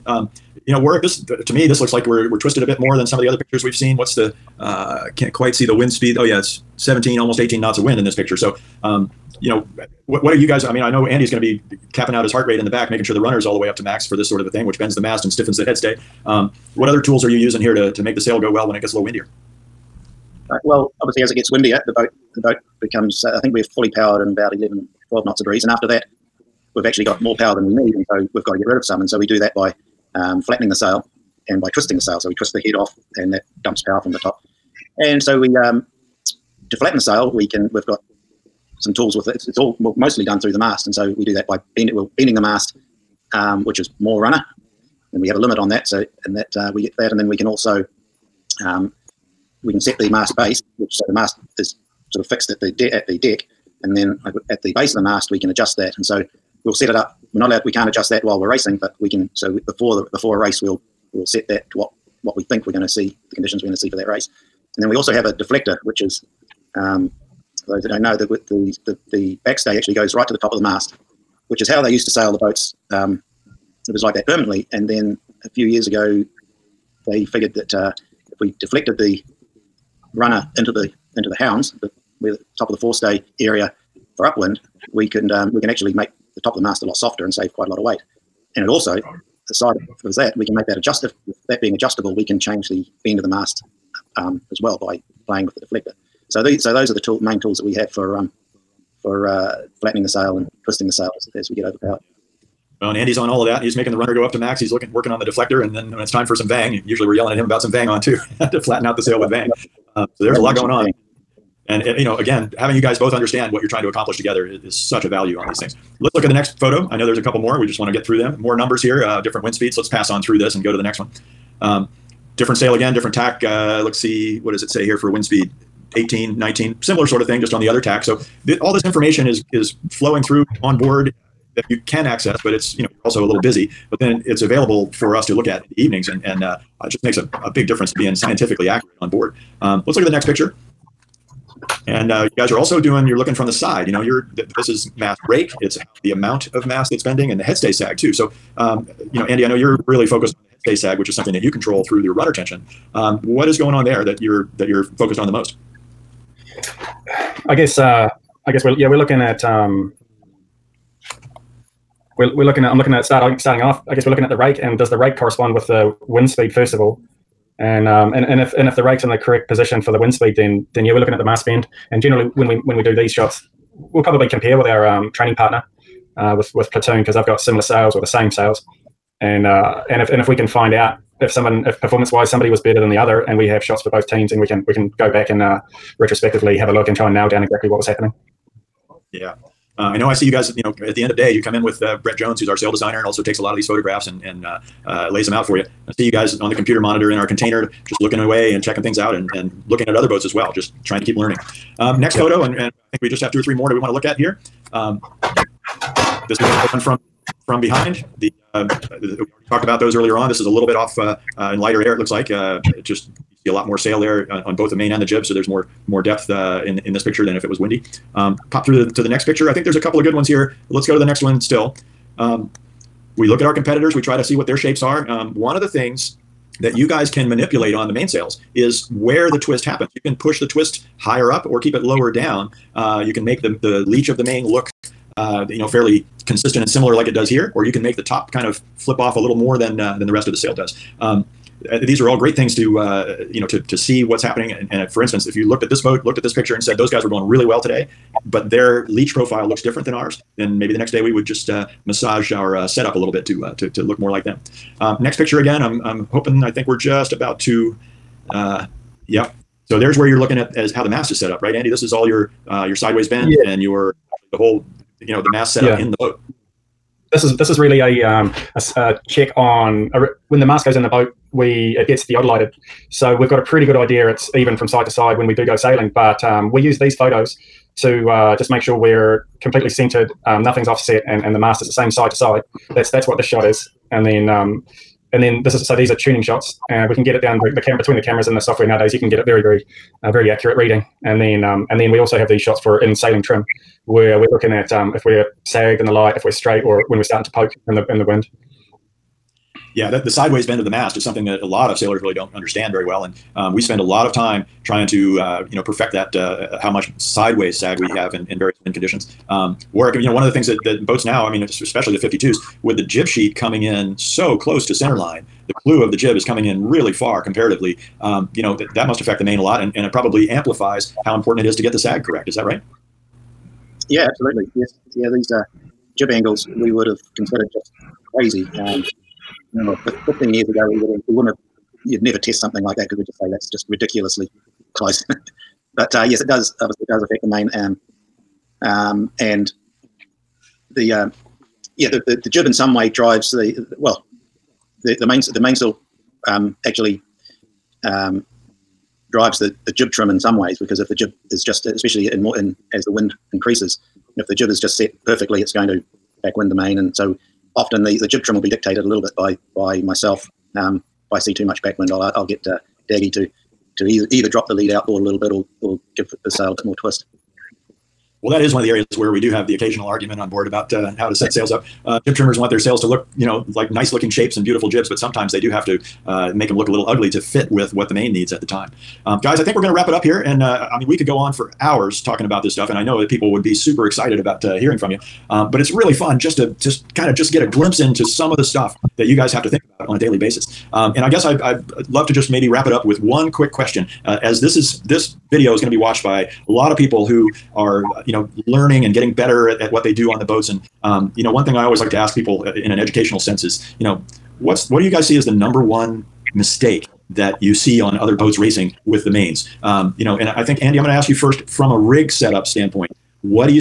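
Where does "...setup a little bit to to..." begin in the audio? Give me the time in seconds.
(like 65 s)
252 s.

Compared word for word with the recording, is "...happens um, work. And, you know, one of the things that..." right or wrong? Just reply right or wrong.
wrong.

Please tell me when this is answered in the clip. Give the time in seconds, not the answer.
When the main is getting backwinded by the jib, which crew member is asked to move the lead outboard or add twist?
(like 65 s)
362 s.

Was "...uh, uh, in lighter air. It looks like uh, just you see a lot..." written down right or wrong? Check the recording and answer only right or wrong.
right.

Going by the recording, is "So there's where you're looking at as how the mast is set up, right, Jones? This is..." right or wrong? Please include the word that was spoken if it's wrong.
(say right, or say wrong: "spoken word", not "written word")
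wrong: "Andy", not "Jones".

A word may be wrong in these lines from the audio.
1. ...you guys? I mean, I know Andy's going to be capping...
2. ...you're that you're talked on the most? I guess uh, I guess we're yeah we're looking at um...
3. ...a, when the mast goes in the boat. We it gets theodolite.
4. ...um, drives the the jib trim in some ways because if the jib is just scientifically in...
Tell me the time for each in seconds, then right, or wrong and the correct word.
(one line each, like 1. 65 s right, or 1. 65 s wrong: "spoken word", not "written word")
1. 10 s right
2. 154 s wrong: "focused", not "talked"
3. 269 s right
4. 347 s wrong: "especially", not "scientifically".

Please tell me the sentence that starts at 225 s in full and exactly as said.
Um, one of the things that you guys can manipulate on the mainsails is where the twist happens.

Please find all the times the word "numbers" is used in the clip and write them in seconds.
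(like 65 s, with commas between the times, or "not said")
118 s, 405 s.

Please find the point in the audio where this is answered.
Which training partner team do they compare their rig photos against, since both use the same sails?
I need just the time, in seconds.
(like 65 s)
176 s.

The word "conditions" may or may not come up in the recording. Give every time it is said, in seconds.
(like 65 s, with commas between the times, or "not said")
63 s, 308 s.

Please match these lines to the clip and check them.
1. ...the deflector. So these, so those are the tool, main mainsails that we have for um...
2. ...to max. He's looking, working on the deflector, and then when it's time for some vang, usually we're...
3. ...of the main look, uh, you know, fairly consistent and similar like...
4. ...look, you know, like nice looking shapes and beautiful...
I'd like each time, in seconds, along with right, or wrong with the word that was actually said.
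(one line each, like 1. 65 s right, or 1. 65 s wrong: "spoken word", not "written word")
1. 95 s wrong: "tools", not "mainsails"
2. 104 s right
3. 234 s right
4. 372 s right.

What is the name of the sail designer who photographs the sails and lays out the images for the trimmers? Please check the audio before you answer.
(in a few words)
Brett Jones.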